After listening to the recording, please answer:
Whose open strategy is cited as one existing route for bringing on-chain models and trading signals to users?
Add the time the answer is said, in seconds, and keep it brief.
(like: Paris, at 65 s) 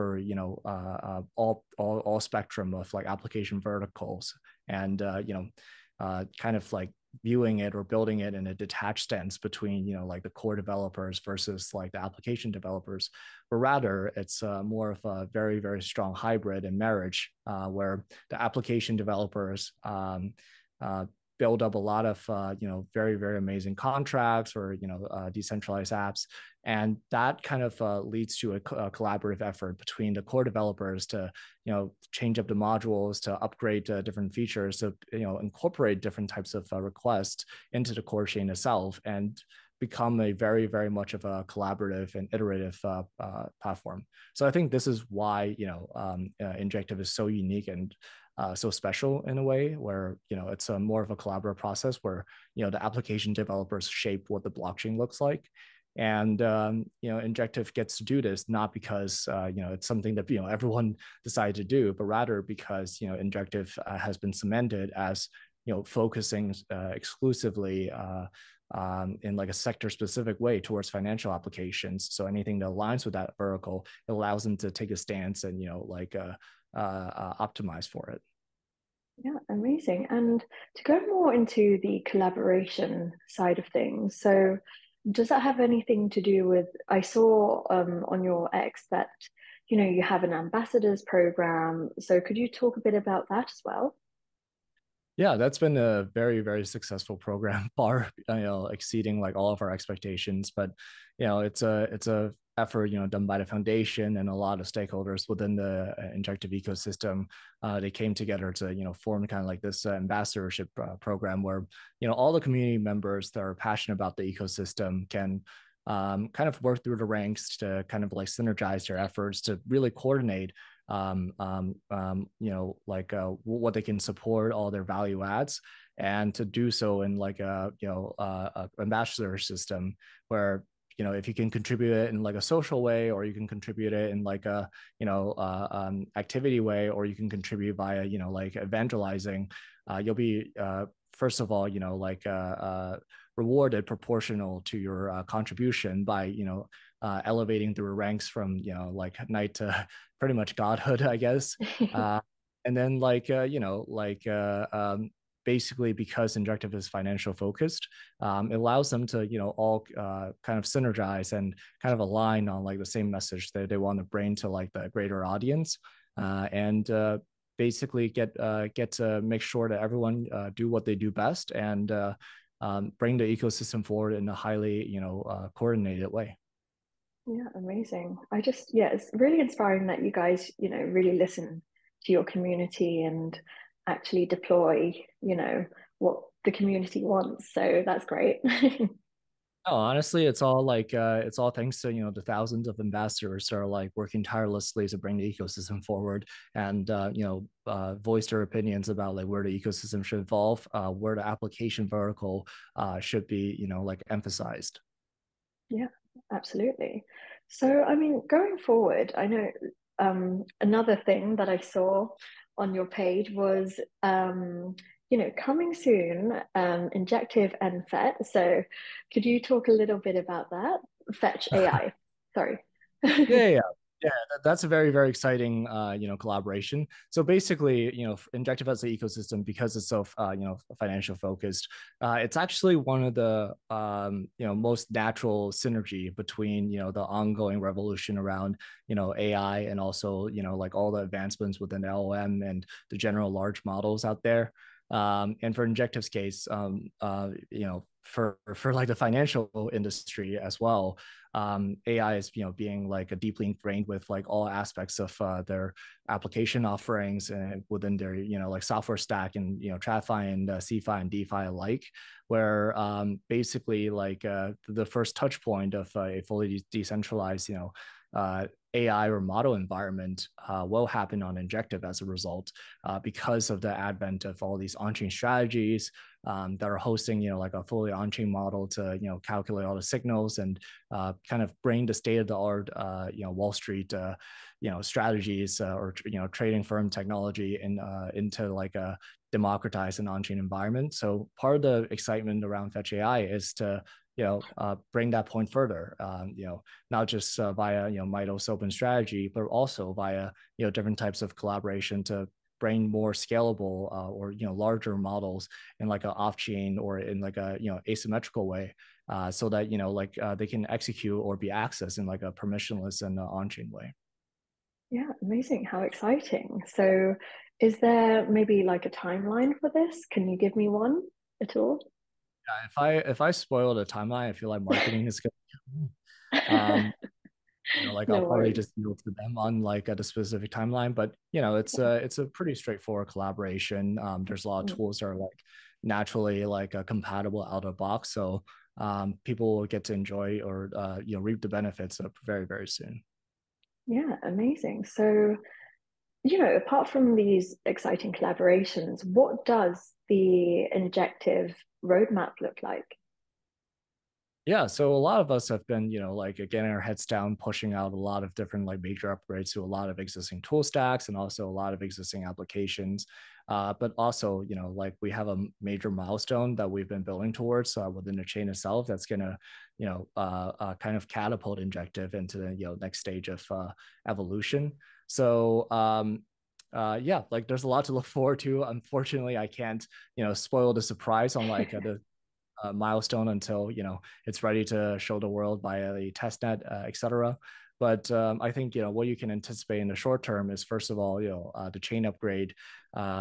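Mito, at 298 s.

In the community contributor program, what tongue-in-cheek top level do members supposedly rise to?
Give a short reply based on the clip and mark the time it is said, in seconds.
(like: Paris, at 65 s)
Godhood, at 150 s.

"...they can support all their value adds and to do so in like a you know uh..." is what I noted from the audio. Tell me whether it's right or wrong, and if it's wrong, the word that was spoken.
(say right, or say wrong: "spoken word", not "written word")
right.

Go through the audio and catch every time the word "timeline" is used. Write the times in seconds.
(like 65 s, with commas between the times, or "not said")
318 s, 323 s, 330 s.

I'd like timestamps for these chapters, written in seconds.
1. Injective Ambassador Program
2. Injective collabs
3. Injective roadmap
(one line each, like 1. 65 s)
1. 80 s
2. 224 s
3. 349 s.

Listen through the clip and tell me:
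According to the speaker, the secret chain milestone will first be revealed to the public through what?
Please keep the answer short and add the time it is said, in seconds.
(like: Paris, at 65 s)
The testnet, at 386 s.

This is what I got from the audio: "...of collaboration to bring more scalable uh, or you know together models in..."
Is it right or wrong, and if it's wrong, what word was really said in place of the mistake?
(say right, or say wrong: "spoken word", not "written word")
wrong: "larger", not "together".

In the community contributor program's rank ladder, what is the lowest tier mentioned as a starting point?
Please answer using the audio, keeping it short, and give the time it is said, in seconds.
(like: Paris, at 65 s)
Knight, at 149 s.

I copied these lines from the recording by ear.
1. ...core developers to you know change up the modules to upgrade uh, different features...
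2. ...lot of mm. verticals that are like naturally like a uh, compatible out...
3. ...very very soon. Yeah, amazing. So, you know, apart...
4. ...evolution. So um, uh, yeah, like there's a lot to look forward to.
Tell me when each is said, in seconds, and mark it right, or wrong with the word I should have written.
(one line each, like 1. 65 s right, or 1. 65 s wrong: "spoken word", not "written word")
1. 30 s right
2. 334 s wrong: "tools", not "verticals"
3. 342 s right
4. 374 s right.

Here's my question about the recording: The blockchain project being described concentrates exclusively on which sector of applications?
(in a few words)
Financial applications.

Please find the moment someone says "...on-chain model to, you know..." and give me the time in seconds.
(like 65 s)
277 s.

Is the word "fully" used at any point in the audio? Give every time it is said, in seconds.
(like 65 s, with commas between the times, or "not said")
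266 s, 277 s.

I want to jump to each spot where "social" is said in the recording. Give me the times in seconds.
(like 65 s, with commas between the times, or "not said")
132 s.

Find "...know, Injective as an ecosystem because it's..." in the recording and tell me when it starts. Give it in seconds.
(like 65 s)
228 s.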